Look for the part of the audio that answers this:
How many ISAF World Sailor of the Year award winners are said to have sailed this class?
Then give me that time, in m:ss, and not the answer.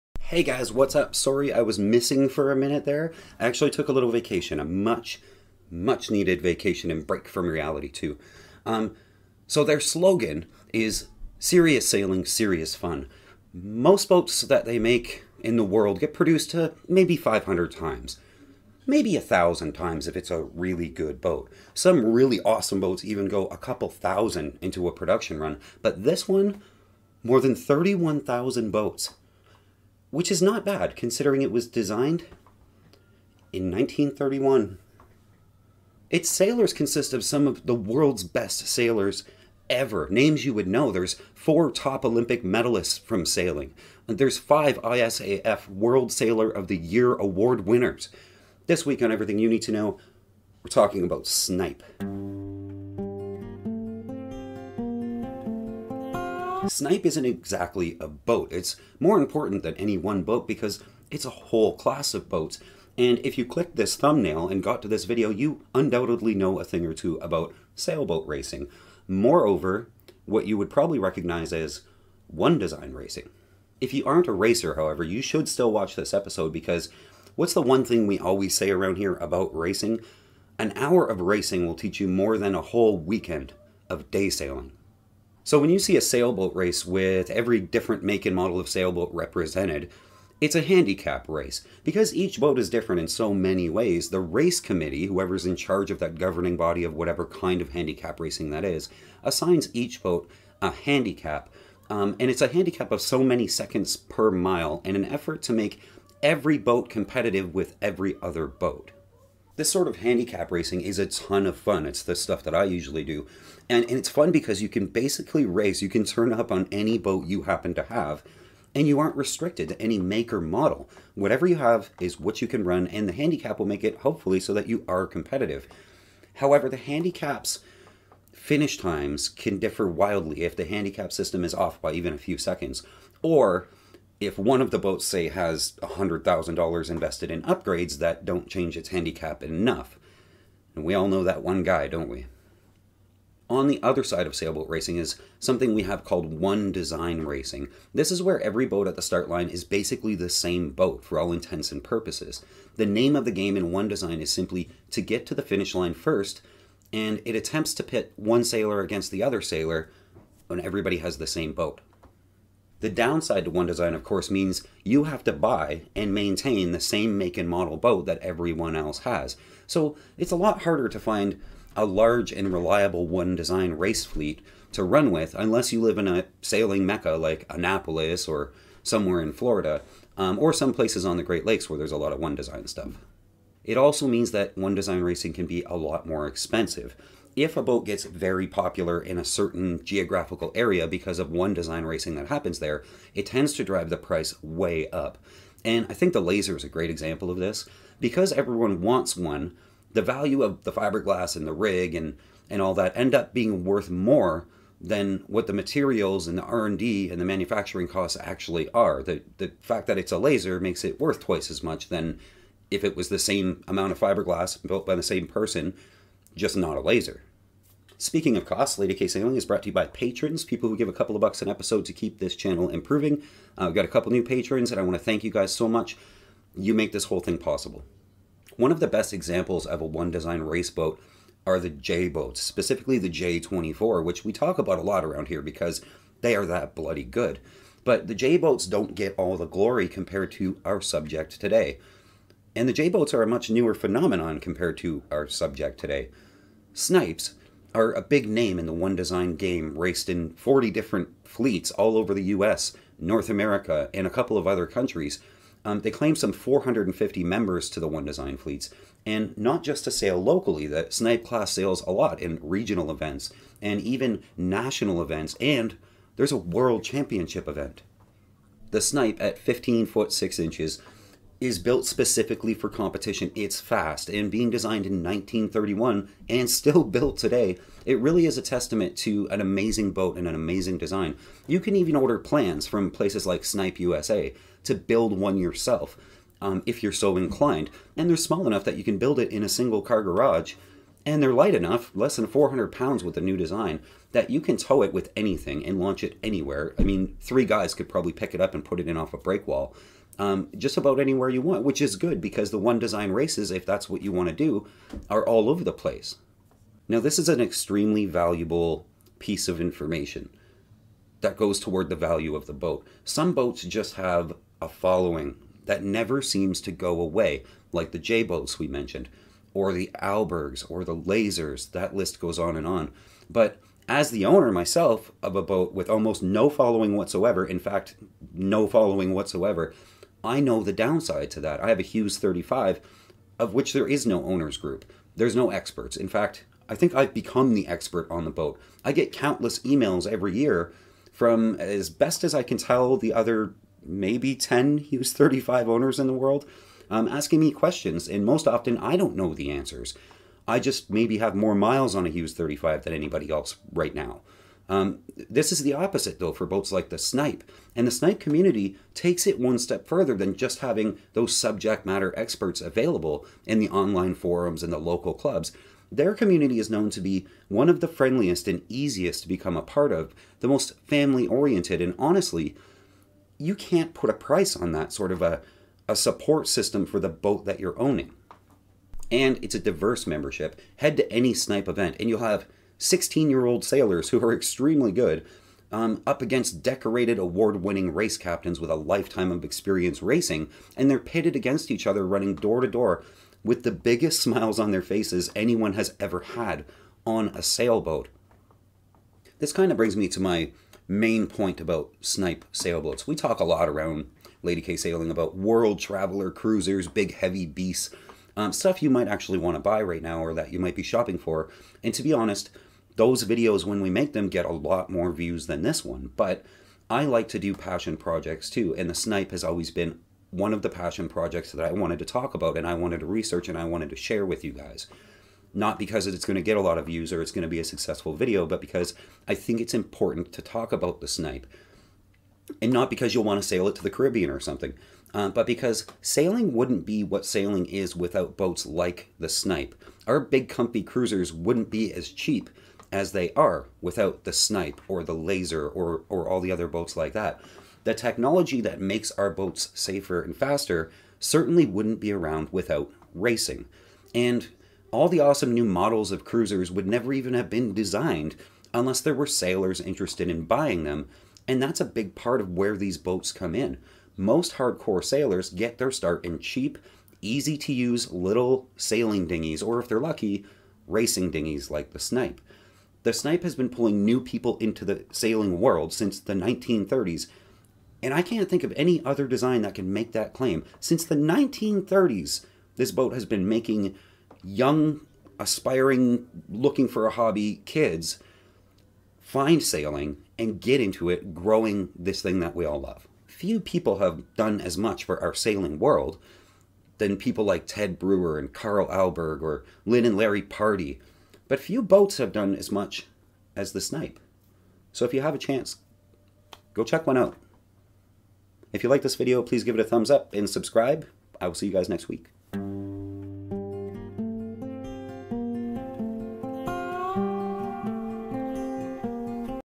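0:44.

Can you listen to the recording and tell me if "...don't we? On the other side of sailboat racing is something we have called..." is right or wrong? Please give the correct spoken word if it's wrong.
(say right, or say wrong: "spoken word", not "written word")
right.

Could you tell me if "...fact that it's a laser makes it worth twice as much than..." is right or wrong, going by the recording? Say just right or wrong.
right.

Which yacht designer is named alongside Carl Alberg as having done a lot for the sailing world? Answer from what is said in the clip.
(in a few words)
Ted Brewer.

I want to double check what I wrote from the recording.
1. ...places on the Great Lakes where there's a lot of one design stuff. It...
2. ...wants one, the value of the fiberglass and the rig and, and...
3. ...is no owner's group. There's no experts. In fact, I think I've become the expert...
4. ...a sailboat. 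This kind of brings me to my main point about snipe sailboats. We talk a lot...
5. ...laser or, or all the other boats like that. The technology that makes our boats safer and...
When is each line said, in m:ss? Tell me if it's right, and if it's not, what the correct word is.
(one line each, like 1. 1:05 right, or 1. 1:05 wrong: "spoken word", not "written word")
1. 3:00 right
2. 3:18 right
3. 5:33 right
4. 6:37 right
5. 7:25 right.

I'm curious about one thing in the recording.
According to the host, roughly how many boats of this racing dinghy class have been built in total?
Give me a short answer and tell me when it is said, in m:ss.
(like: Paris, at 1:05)
more than 31,000, at 0:27.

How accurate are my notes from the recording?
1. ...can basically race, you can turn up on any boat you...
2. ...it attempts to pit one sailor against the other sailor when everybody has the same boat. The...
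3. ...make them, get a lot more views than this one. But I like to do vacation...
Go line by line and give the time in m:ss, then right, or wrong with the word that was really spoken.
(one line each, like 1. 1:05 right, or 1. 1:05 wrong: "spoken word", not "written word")
1. 1:54 right
2. 2:37 right
3. 6:53 wrong: "passion", not "vacation".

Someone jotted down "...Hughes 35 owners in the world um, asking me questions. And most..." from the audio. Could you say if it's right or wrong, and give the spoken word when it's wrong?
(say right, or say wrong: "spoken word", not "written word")
right.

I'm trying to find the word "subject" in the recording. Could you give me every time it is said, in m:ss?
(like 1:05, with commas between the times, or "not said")
4:00, 4:05, 6:01.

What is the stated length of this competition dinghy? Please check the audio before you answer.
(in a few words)
15 feet 6 inches.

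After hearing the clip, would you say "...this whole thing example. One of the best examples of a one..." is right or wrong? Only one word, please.
wrong.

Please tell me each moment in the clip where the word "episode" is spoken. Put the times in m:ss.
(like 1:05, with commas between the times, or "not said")
1:16, 3:41.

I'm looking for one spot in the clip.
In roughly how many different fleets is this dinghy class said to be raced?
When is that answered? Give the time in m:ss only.
4:10.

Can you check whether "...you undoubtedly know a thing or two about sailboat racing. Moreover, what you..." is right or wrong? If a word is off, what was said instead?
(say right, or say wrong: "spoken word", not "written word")
right.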